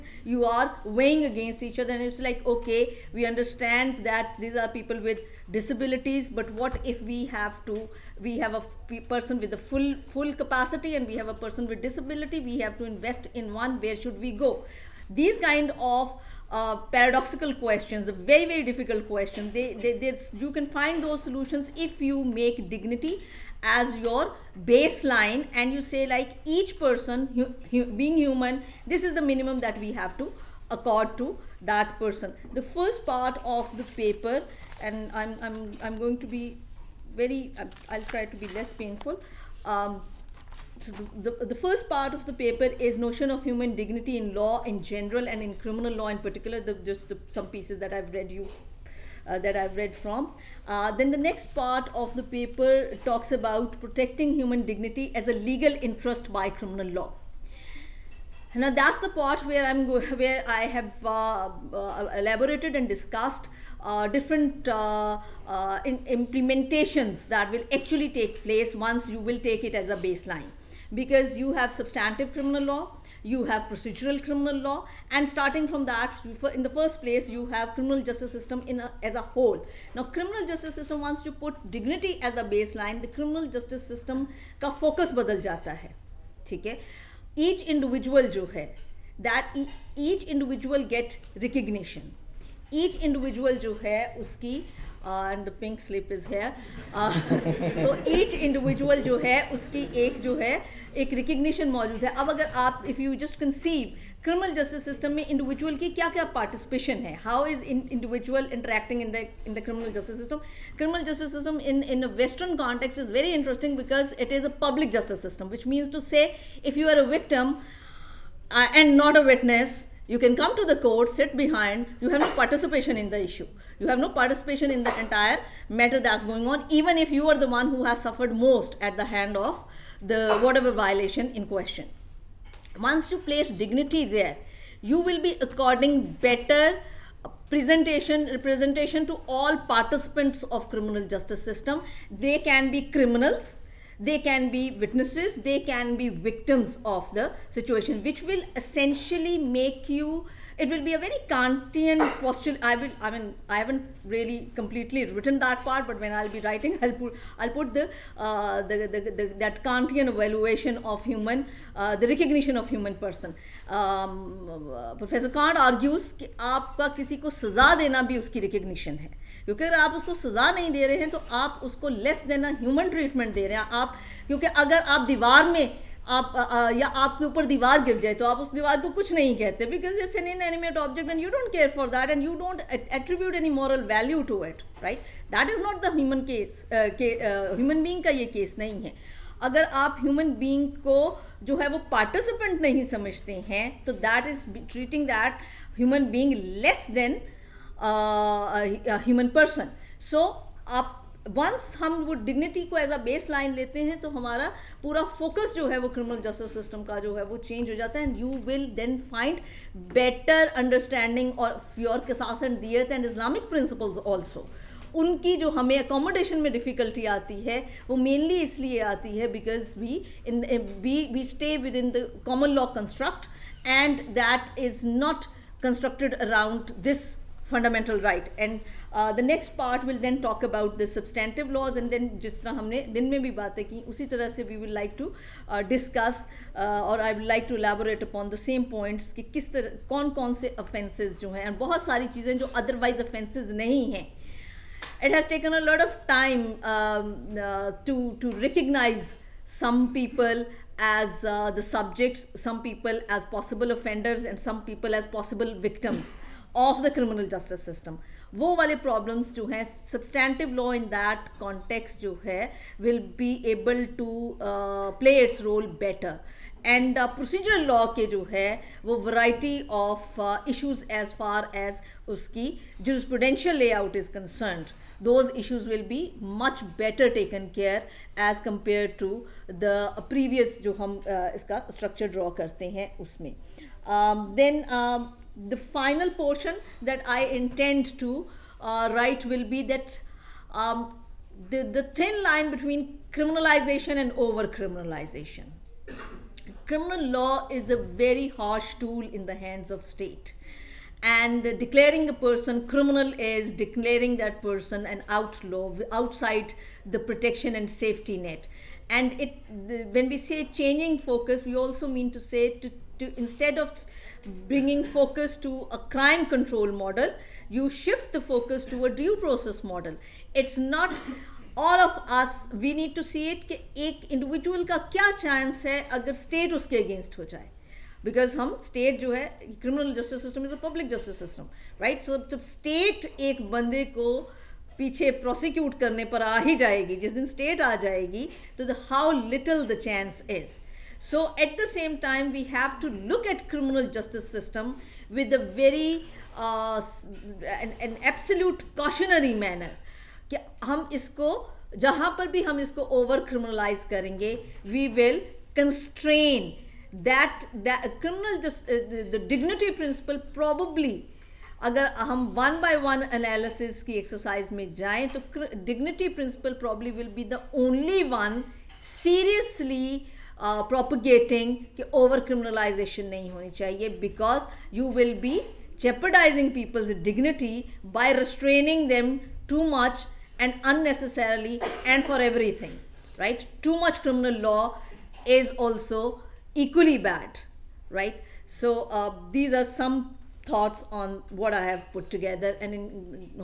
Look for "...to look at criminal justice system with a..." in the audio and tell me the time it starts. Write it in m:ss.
5:42.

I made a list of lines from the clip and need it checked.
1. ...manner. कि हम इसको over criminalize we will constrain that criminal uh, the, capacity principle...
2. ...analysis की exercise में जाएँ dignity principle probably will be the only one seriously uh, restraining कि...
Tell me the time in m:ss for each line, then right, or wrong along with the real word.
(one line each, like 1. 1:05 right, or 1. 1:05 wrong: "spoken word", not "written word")
1. 5:49 wrong: "dignity", not "capacity"
2. 6:03 wrong: "propagating", not "restraining".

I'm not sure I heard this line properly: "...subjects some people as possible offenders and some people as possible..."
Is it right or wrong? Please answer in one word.
right.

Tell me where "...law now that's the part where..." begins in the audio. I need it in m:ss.
0:56.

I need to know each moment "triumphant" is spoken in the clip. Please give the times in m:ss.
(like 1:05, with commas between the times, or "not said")
not said.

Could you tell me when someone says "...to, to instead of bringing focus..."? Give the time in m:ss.
5:12.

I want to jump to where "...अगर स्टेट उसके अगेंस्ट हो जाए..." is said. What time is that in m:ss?
5:25.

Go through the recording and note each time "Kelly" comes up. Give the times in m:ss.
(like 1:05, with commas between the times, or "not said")
not said.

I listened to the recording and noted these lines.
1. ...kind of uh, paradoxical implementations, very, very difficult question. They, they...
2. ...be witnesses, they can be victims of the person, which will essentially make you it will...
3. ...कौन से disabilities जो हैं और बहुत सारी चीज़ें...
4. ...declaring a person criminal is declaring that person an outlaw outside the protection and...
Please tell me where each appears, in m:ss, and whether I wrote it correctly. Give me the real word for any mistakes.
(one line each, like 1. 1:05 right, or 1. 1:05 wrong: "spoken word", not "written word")
1. 0:15 wrong: "questions", not "implementations"
2. 2:24 wrong: "situation", not "person"
3. 4:00 wrong: "offences", not "disabilities"
4. 5:01 right.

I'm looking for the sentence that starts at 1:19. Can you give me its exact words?
Now, criminal justice system wants to put dignity as the baseline.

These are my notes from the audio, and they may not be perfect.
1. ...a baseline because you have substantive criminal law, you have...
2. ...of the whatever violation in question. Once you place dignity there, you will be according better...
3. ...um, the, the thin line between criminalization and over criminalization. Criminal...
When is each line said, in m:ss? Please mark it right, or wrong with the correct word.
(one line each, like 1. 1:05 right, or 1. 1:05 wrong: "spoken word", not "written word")
1. 1:09 right
2. 2:09 right
3. 4:50 right.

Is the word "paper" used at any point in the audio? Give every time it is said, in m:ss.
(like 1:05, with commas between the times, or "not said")
0:33, 0:42, 0:52.